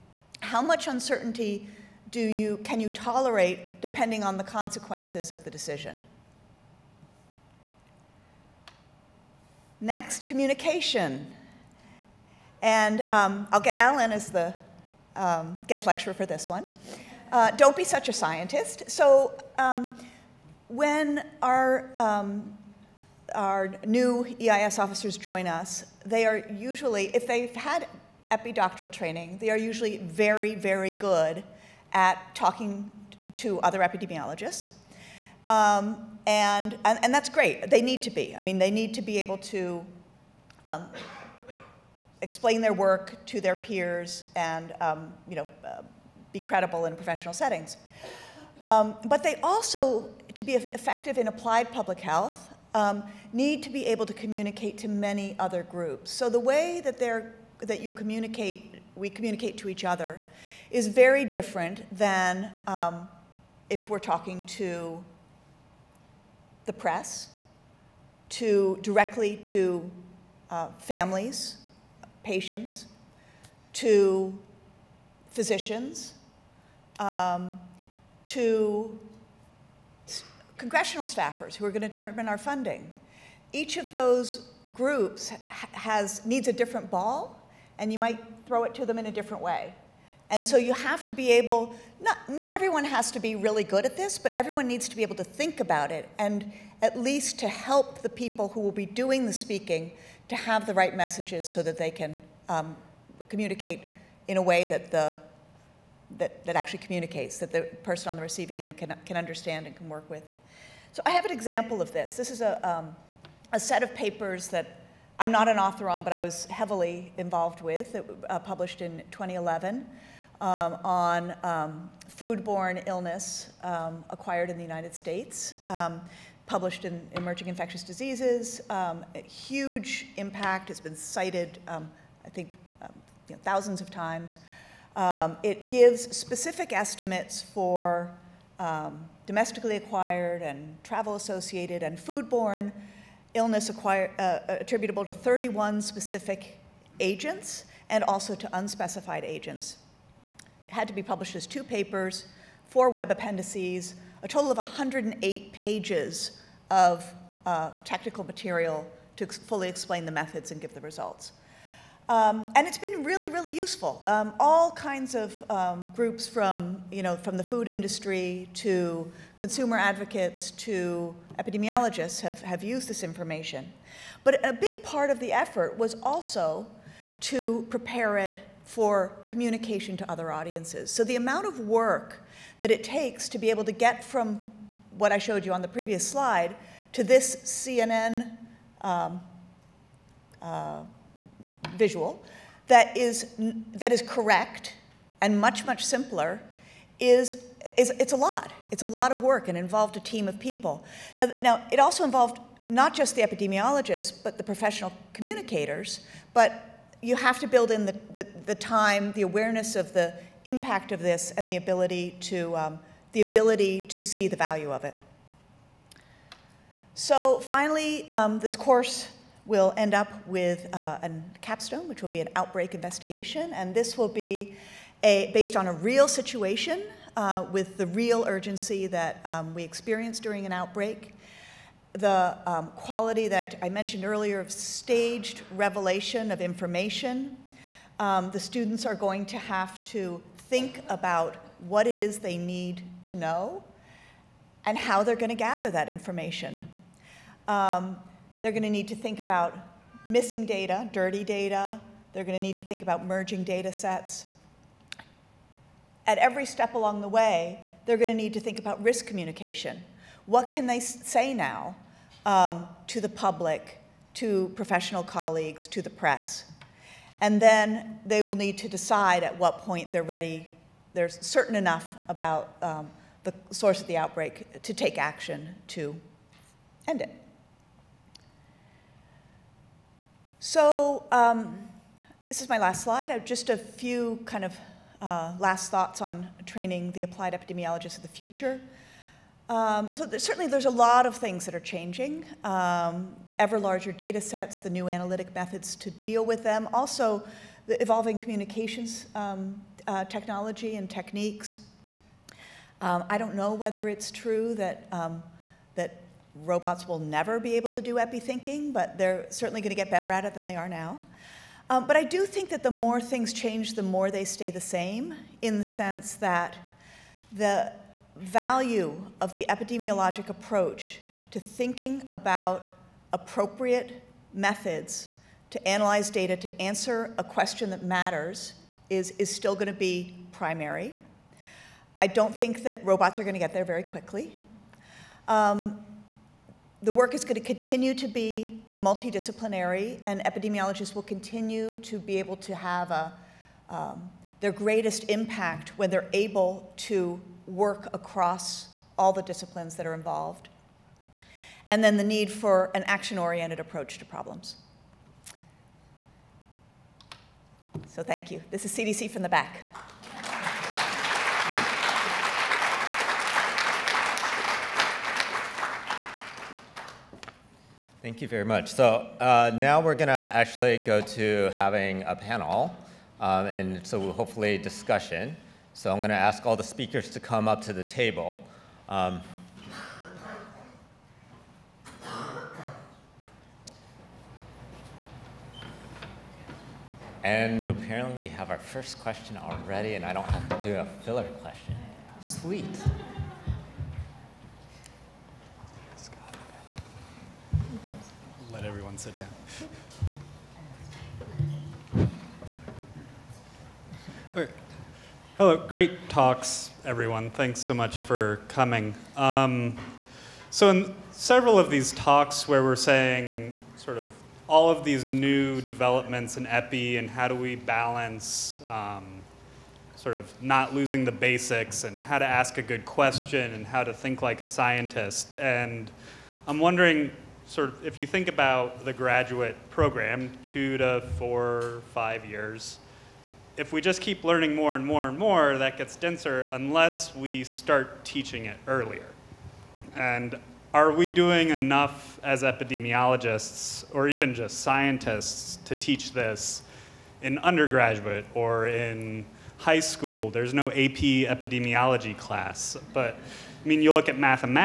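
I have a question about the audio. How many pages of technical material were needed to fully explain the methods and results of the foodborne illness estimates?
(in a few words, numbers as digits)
108.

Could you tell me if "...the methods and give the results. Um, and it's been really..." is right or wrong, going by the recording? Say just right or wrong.
right.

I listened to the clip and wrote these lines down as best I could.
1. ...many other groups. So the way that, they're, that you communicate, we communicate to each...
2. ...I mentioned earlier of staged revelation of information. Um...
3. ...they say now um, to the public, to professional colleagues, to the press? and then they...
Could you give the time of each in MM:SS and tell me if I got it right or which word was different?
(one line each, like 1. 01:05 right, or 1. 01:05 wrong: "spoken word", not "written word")
1. 00:54 right
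2. 03:53 right
3. 04:20 right.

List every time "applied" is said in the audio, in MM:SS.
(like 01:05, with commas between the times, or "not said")
00:51, 04:47.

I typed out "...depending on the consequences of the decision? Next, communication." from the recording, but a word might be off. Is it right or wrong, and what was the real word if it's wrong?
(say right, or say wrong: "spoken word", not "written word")
right.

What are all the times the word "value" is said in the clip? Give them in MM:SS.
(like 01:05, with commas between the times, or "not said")
03:34, 05:18.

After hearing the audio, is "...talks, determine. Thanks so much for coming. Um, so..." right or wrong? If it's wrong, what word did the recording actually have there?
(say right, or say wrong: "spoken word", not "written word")
wrong: "everyone", not "determine".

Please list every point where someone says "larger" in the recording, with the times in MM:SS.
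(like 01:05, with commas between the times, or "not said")
04:53.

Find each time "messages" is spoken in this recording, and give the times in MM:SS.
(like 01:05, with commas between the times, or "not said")
01:40.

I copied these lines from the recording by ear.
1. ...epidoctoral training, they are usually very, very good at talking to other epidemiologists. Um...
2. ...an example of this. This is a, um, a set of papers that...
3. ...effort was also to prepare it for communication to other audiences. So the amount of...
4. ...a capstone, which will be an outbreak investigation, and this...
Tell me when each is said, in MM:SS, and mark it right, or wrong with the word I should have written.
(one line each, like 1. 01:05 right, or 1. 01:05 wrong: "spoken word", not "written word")
1. 00:28 right
2. 01:51 right
3. 02:55 right
4. 03:41 right.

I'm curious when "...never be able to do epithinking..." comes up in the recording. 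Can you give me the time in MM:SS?
05:06.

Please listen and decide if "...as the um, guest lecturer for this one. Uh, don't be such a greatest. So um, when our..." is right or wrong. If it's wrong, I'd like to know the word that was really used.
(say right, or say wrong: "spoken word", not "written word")
wrong: "scientist", not "greatest".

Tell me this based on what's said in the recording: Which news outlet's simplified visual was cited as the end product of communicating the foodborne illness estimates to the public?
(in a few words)
CNN.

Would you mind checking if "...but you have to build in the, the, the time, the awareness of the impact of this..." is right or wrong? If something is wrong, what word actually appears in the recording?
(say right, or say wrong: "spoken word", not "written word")
right.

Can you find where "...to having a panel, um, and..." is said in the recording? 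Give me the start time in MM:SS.
06:10.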